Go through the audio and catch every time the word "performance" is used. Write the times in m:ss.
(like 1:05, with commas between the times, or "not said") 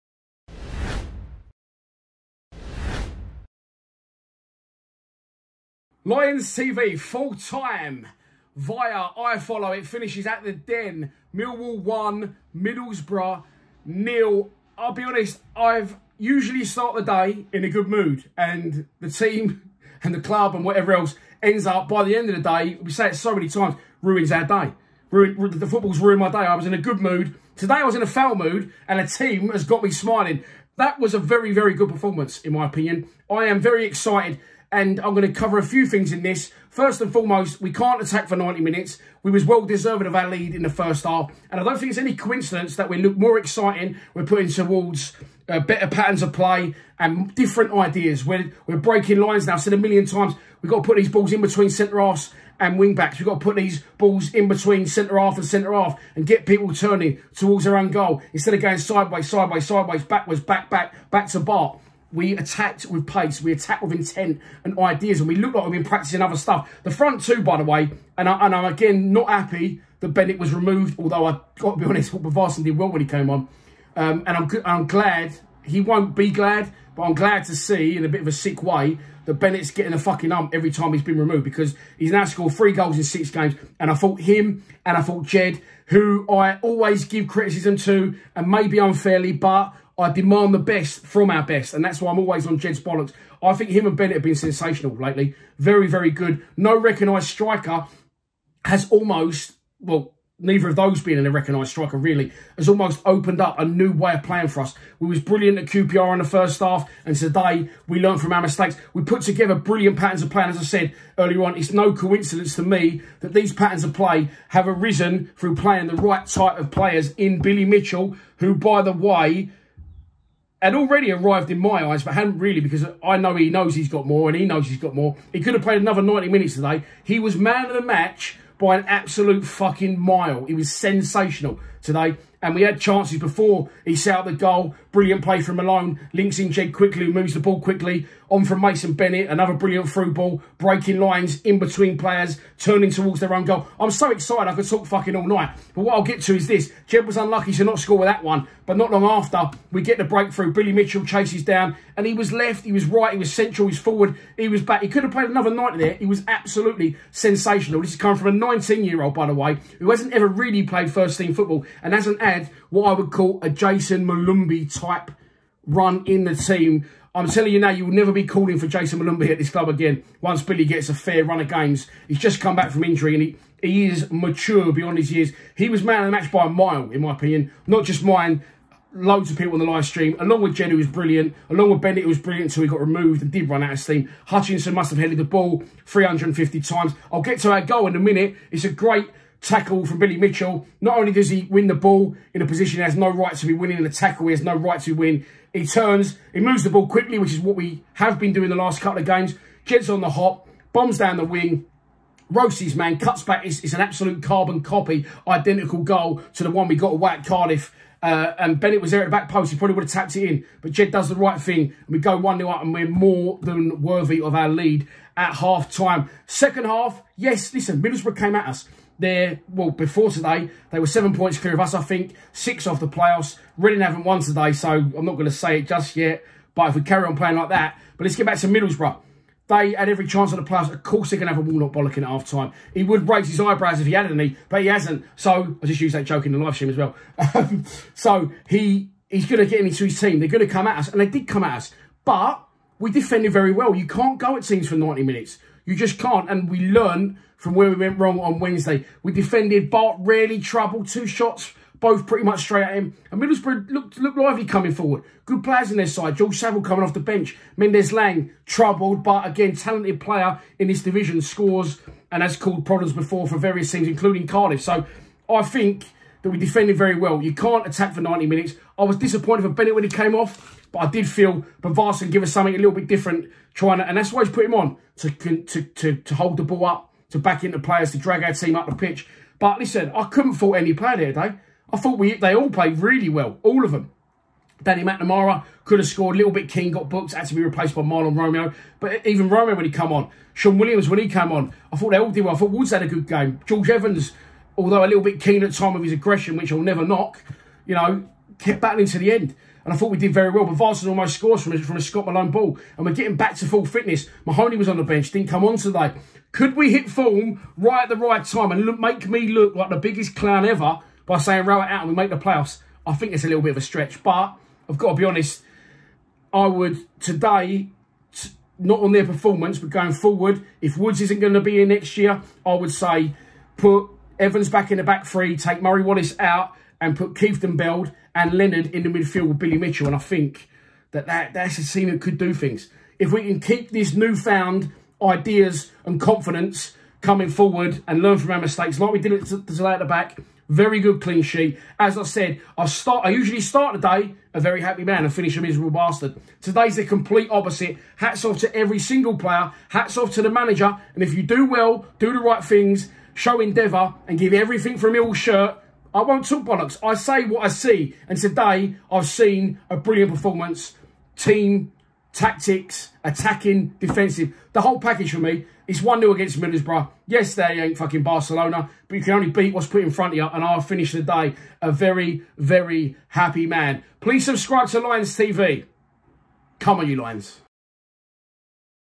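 0:31, 5:19, 6:00.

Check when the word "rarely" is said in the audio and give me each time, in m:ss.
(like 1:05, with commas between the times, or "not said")
4:09.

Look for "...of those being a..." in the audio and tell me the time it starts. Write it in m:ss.
1:40.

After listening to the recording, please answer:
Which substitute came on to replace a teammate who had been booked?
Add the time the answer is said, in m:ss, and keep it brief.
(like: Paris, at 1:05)
Mahlon Romeo, at 4:47.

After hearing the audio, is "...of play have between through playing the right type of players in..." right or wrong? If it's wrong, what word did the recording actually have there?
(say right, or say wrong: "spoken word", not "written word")
wrong: "arisen", not "between".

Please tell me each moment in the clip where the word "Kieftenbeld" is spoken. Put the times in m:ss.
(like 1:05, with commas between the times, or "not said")
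5:27.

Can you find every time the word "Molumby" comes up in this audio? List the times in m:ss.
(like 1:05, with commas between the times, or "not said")
2:44, 2:48.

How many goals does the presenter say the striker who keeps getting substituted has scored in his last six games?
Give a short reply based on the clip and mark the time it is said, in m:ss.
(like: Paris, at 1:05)
3, at 1:22.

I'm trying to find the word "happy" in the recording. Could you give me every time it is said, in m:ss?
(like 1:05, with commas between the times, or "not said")
1:09, 5:44, 6:13.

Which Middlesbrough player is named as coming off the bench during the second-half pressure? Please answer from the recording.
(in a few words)
George Saville.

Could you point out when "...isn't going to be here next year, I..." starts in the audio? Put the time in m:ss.
5:21.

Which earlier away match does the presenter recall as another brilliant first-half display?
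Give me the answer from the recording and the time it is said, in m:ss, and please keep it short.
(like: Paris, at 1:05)
QPR, at 1:45.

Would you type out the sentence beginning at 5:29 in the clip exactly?
And I think that, that that's a team that could do things.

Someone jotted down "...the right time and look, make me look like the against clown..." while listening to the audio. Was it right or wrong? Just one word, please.
wrong.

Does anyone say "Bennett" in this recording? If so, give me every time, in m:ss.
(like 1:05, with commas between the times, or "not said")
1:10, 1:19, 1:33, 2:18, 3:01, 3:28, 4:29.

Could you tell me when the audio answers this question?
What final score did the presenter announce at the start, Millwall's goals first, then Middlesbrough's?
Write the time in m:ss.
0:11.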